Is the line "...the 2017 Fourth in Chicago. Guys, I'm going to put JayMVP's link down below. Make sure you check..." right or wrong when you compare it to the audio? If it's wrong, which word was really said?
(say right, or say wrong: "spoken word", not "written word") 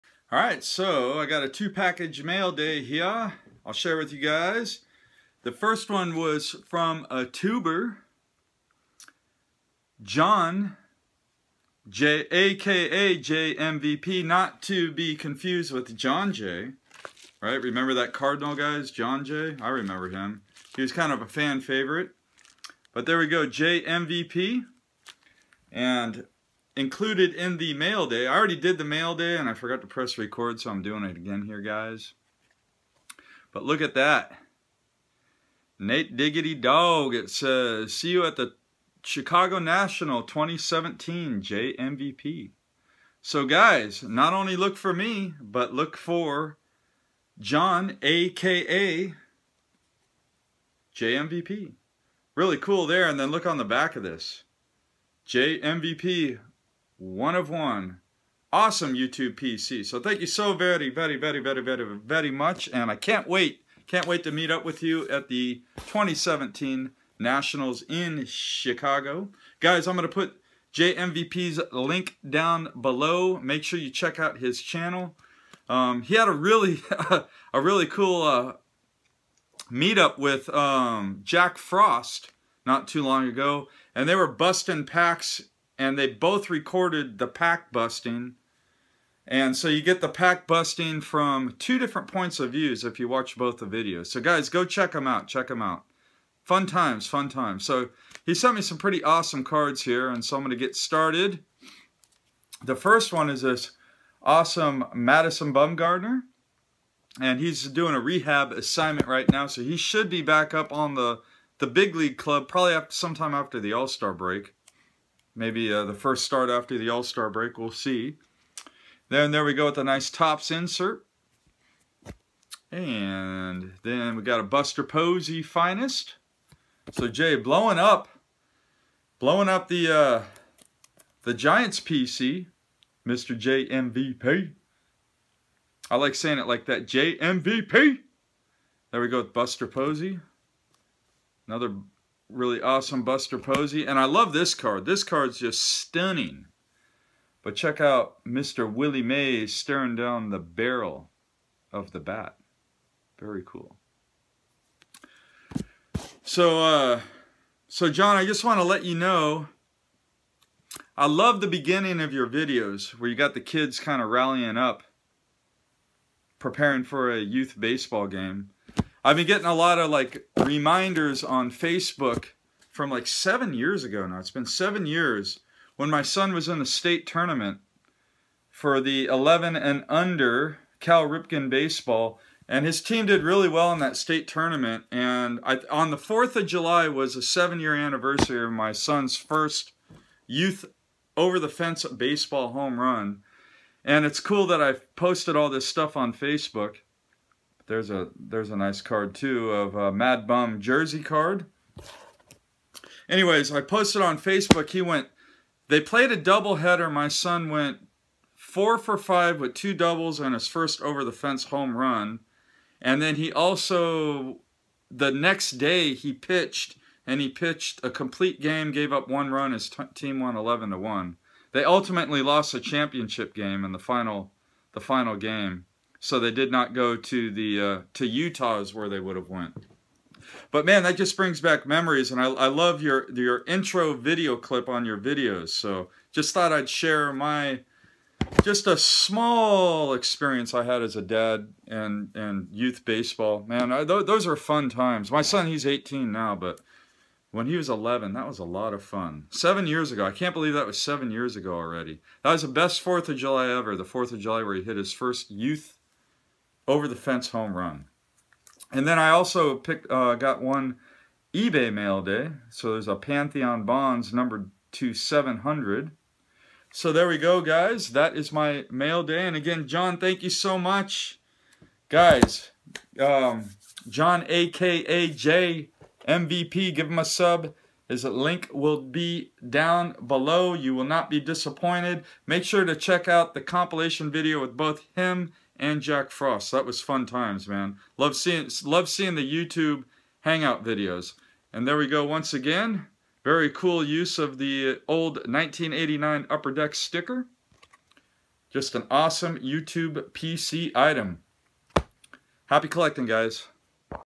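wrong: "Nationals", not "Fourth".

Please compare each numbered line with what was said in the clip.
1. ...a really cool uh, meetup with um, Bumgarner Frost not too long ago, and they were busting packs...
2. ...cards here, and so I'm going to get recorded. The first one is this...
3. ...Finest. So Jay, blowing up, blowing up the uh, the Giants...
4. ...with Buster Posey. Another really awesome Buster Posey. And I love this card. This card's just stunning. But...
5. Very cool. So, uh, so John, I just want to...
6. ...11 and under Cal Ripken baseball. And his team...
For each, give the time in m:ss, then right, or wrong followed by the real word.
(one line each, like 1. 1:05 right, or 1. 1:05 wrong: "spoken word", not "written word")
1. 1:17 wrong: "Jack", not "Bumgarner"
2. 1:39 wrong: "started", not "recorded"
3. 2:05 right
4. 2:19 right
5. 2:33 right
6. 2:59 right.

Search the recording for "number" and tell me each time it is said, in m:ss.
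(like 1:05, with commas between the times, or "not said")
4:24.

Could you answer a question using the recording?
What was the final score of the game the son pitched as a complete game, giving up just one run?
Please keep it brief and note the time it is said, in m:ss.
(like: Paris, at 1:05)
11 to 1, at 3:40.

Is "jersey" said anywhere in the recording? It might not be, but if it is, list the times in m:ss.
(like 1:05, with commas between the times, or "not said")
3:20.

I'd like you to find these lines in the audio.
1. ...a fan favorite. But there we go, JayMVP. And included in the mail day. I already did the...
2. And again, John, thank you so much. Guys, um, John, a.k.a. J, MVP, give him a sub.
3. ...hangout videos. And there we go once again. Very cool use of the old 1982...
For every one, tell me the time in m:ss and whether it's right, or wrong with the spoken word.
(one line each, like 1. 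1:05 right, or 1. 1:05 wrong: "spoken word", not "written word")
1. 0:21 right
2. 4:29 right
3. 4:50 wrong: "1989", not "1982".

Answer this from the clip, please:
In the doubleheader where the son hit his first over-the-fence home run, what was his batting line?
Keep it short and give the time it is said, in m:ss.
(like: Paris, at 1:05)
4 for 5, at 3:28.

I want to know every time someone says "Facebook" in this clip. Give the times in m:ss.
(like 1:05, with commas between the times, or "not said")
2:51, 3:16, 3:24.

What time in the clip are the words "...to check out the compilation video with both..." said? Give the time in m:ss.
4:42.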